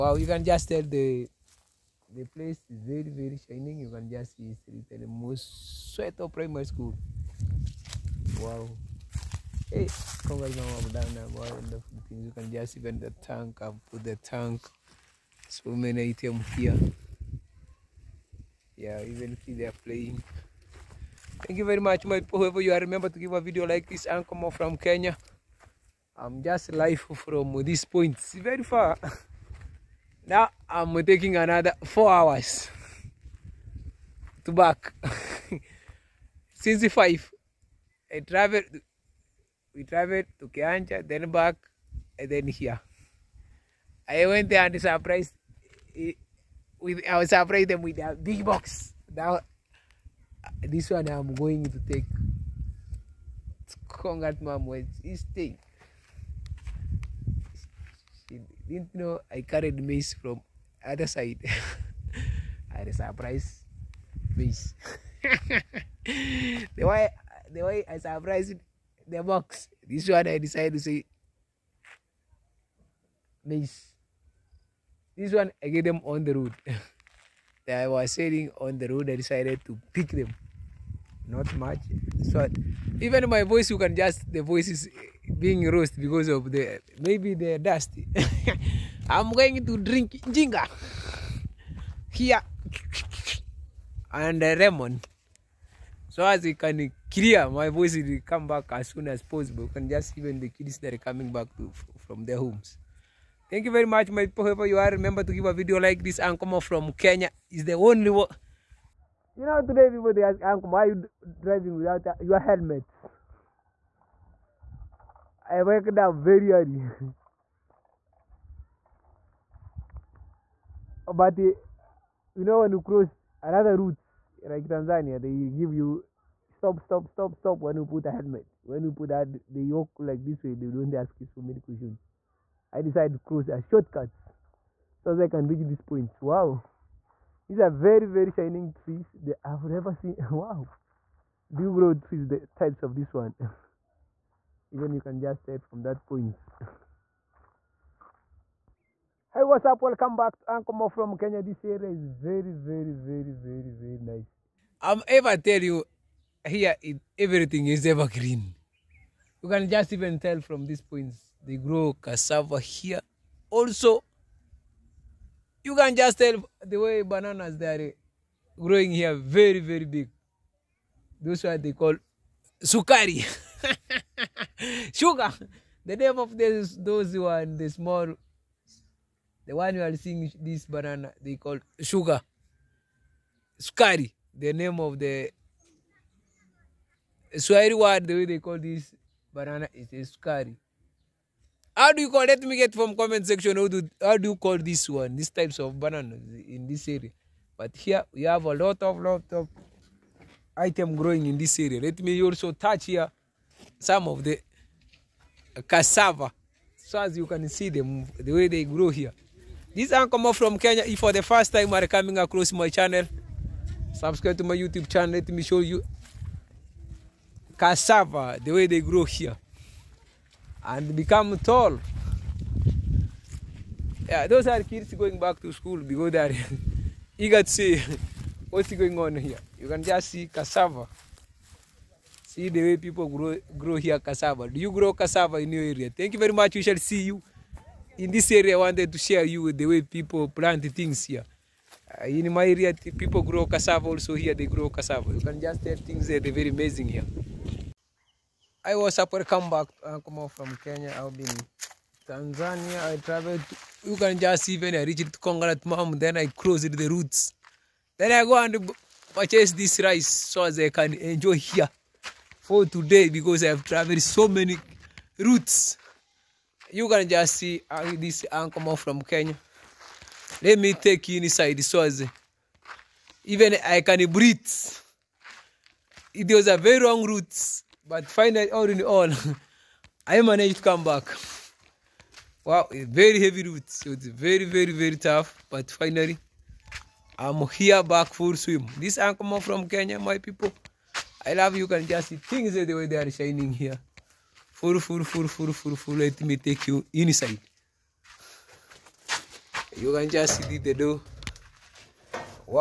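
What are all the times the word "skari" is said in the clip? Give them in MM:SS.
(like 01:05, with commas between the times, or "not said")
03:03, 03:10.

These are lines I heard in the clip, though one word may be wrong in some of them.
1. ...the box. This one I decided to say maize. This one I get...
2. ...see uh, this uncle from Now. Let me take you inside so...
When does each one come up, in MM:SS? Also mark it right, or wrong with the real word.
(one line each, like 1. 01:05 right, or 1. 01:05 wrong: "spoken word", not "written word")
1. 01:09 right
2. 04:27 wrong: "Kenya", not "Now".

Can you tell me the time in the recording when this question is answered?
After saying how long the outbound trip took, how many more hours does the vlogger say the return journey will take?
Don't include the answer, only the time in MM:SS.
00:31.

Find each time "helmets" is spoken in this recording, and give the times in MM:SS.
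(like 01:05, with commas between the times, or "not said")
01:52, 02:08.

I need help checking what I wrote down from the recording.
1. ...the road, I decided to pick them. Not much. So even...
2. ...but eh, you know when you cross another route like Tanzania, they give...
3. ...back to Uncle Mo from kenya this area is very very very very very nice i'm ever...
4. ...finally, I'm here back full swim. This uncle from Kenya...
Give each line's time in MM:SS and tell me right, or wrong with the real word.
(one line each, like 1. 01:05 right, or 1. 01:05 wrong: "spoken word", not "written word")
1. 01:18 right
2. 02:01 right
3. 02:30 right
4. 04:45 right.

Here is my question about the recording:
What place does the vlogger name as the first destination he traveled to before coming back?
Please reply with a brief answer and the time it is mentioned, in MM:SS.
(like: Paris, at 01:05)
Kianja, at 00:40.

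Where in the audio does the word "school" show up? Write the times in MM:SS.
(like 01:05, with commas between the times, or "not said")
00:06, 03:45.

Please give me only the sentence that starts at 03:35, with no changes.
Let me show you cassava, the way they grow here.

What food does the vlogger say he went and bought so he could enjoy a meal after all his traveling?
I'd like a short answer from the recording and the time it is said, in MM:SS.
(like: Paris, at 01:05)
Rice, at 04:19.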